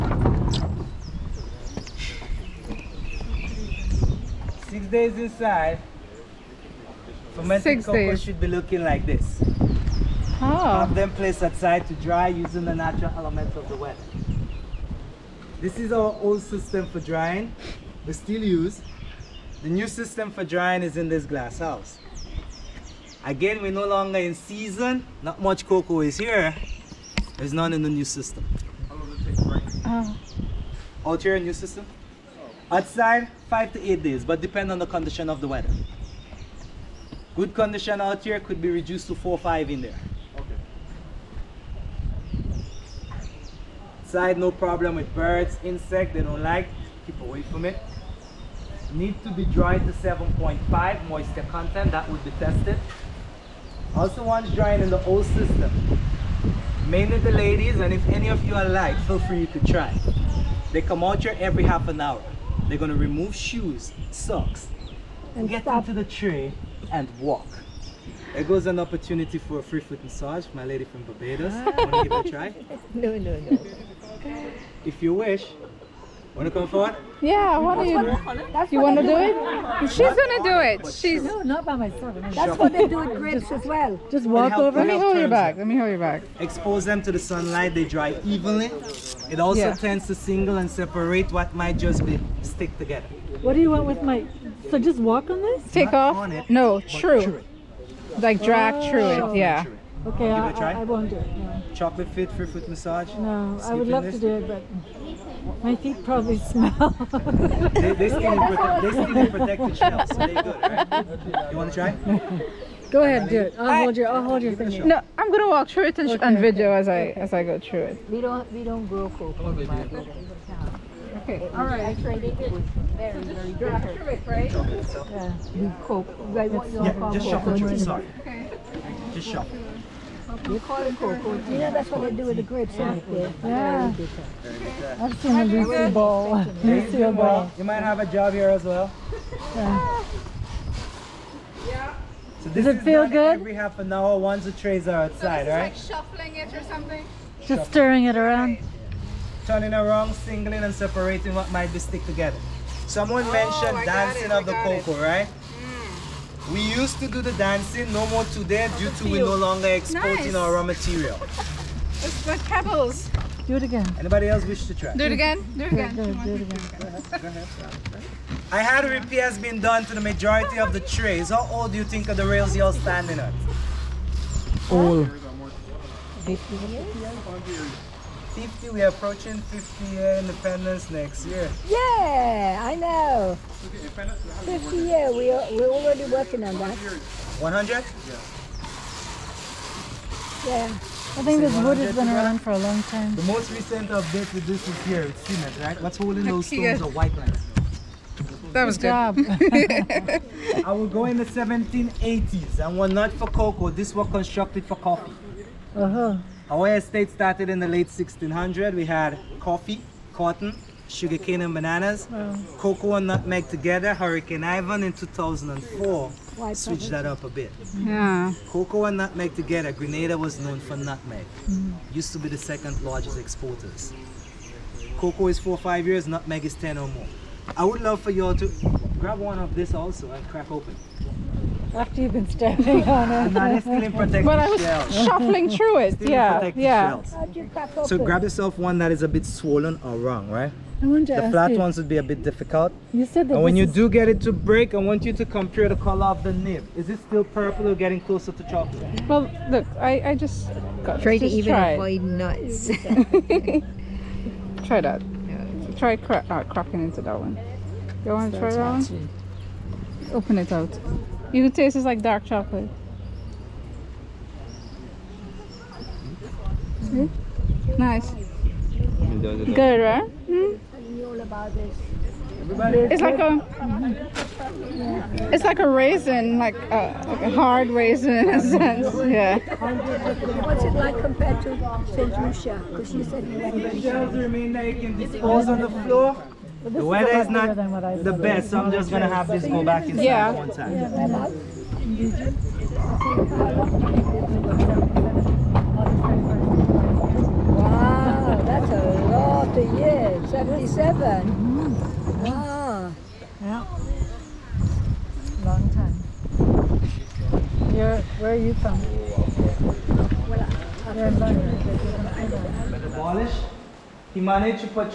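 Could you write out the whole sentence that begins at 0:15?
This is our old system for drying.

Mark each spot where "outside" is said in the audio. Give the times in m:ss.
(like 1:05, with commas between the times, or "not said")
0:11, 0:32, 0:44, 2:25.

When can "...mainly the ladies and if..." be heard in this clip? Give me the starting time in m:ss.
0:56.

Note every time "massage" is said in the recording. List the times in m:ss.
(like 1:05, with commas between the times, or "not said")
1:10, 1:42.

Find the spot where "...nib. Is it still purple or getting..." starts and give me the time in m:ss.
4:06.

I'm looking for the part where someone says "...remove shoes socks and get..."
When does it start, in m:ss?
1:02.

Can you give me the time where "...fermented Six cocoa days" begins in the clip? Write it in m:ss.
0:07.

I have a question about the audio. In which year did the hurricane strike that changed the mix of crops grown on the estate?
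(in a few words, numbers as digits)
2004.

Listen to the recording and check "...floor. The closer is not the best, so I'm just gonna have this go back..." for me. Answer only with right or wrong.
wrong.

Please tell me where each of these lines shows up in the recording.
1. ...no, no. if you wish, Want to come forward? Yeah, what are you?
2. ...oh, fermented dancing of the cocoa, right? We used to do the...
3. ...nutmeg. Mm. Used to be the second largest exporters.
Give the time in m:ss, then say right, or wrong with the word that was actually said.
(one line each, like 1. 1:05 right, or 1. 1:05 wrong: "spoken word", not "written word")
1. 1:13 right
2. 2:33 wrong: "mentioned", not "fermented"
3. 3:40 right.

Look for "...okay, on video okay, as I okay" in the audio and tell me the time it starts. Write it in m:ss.
1:56.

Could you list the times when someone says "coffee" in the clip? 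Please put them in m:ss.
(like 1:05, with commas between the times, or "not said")
3:24, 3:29.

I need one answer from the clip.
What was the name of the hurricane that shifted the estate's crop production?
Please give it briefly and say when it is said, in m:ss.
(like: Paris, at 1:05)
Hurricane Ivan, at 3:33.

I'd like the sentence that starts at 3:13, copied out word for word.
The most recent update to this is here, it's cement, right?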